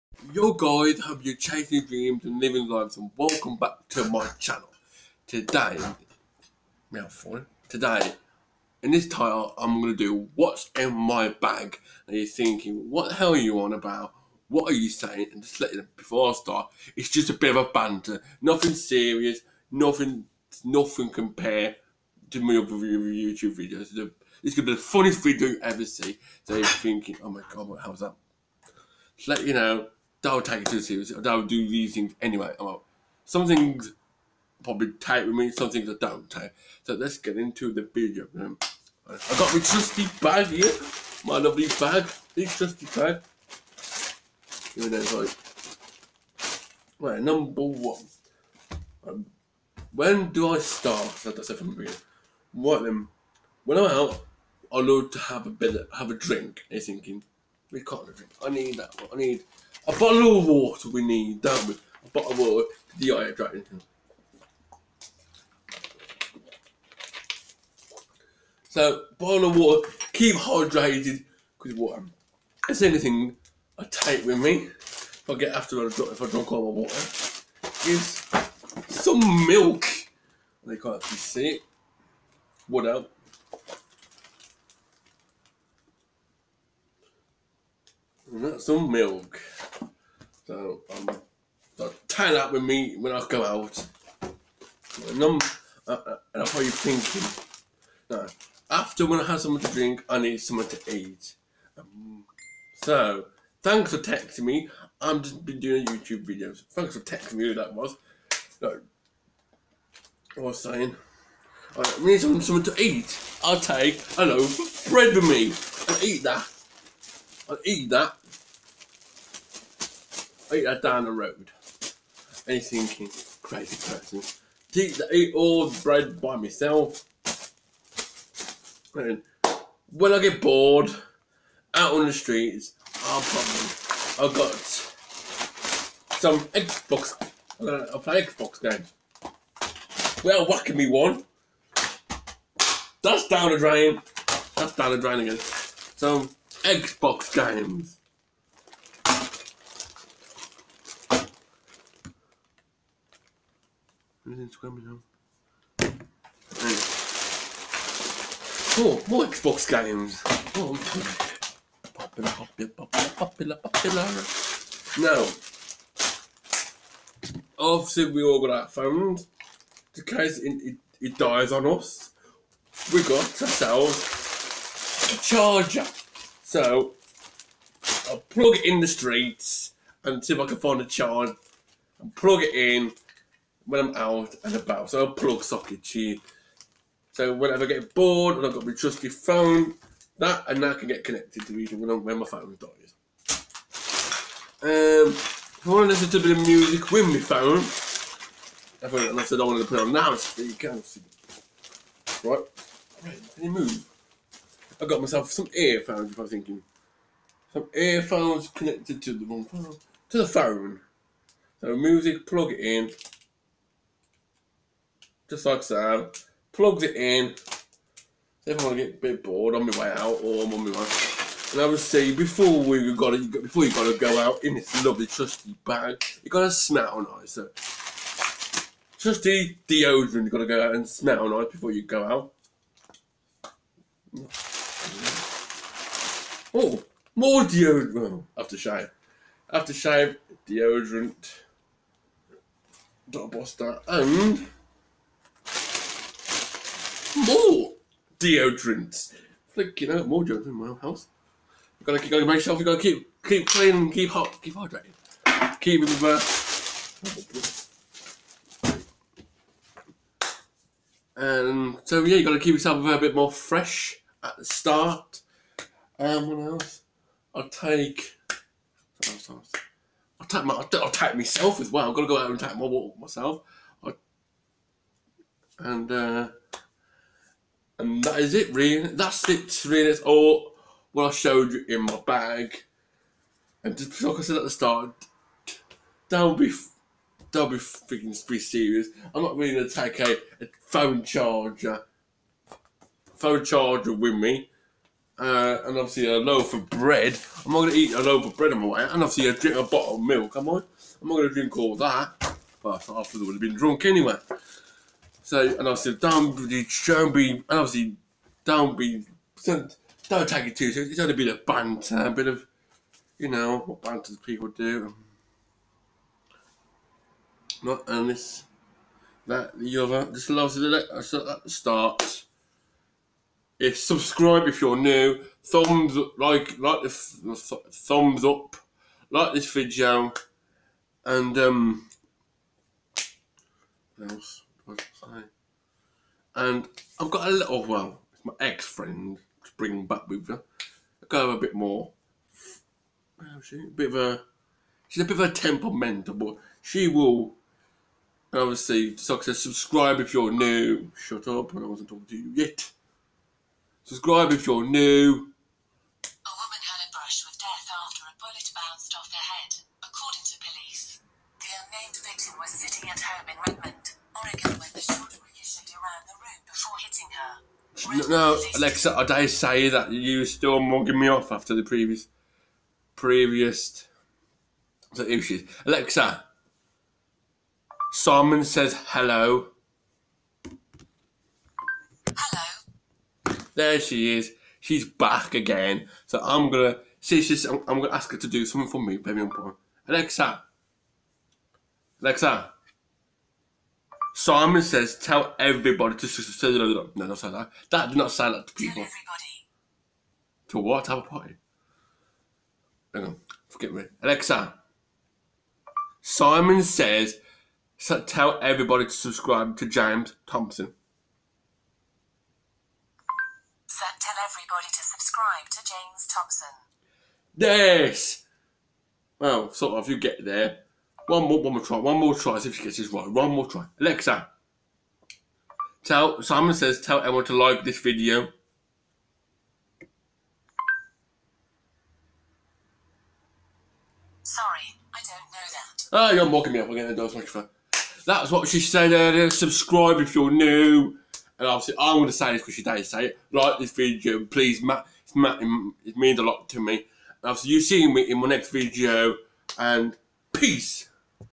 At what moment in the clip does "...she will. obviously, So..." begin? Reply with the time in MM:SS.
05:46.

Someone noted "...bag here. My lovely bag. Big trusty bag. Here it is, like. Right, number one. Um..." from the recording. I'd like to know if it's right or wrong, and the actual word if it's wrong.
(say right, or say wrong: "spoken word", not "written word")
right.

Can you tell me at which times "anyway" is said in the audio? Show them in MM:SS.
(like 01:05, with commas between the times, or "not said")
00:32, 05:03.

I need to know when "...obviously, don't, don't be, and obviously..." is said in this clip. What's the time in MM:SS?
05:05.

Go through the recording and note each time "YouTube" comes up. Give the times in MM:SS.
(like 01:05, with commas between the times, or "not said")
00:22, 01:45.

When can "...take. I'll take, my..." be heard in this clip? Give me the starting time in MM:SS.
04:27.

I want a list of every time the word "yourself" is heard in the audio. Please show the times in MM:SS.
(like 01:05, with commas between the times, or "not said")
04:12, 04:22.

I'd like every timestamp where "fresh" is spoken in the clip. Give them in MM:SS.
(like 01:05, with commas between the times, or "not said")
04:23.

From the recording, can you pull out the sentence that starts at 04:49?
I'm not really gonna take a, a phone charger, phone charger with me.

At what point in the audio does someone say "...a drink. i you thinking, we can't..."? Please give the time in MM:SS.
00:56.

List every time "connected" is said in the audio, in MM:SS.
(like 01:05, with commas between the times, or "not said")
03:11, 03:28.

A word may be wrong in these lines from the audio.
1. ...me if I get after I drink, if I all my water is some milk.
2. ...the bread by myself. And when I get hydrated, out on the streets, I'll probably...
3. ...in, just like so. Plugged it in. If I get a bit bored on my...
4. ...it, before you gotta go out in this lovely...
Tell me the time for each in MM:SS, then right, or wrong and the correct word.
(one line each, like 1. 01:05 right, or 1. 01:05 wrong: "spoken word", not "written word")
1. 01:14 right
2. 02:05 wrong: "bored", not "hydrated"
3. 03:32 right
4. 03:43 right.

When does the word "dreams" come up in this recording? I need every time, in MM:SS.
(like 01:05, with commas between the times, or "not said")
00:01.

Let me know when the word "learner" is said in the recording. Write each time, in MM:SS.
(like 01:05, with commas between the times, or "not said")
not said.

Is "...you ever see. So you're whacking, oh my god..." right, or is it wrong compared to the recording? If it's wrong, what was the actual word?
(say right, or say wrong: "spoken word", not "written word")
wrong: "thinking", not "whacking".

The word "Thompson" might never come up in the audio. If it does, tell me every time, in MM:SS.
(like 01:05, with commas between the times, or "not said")
06:50, 06:56.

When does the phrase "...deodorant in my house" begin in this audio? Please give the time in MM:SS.
04:10.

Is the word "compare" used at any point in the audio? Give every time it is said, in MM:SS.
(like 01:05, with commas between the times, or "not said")
00:21.